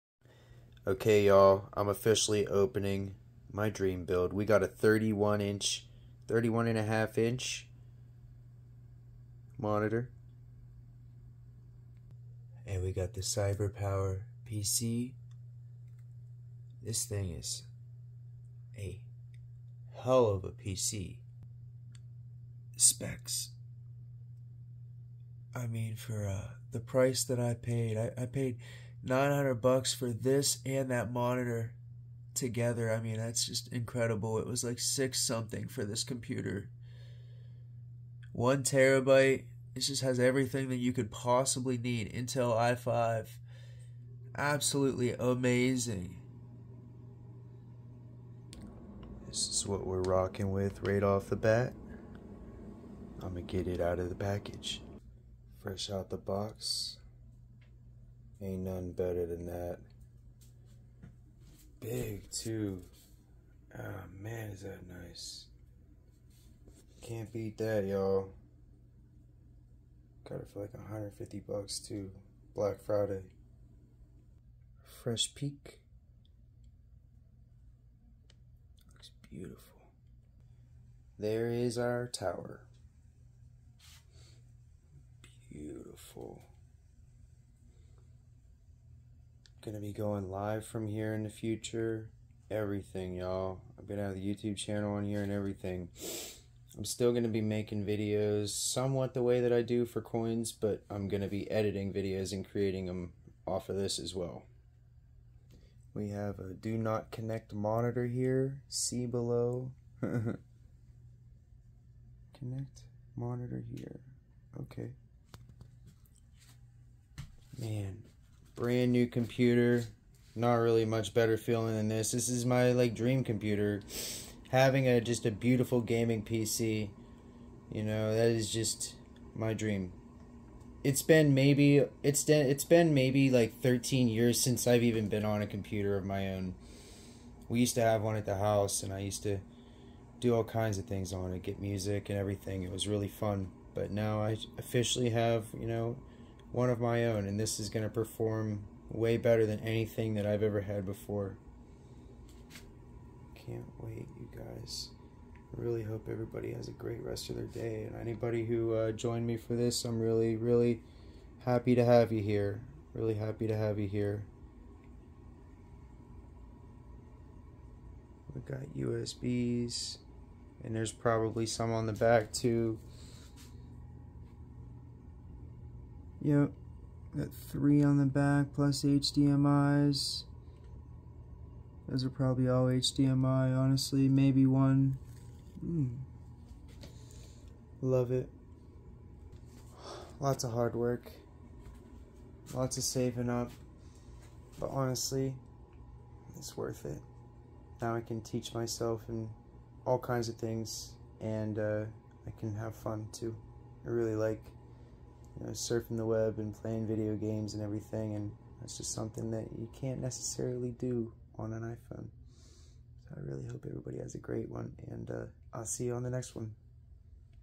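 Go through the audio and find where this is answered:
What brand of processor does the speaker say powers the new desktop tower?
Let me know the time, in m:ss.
0:42.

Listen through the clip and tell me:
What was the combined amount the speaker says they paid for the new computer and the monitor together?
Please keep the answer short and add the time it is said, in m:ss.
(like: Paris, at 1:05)
$900, at 0:29.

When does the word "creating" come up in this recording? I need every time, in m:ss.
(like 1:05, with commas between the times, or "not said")
1:42.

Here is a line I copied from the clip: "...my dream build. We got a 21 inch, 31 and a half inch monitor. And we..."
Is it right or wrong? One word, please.
wrong.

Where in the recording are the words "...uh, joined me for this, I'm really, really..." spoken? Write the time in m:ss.
2:38.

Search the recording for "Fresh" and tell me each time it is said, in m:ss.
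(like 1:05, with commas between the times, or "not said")
0:55, 1:14.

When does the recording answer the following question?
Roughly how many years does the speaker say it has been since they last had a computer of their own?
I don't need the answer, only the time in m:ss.
2:13.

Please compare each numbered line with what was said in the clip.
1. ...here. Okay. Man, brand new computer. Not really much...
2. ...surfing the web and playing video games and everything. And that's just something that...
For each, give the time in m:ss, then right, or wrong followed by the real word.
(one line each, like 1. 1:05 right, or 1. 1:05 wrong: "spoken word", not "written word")
1. 1:53 right
2. 3:25 right.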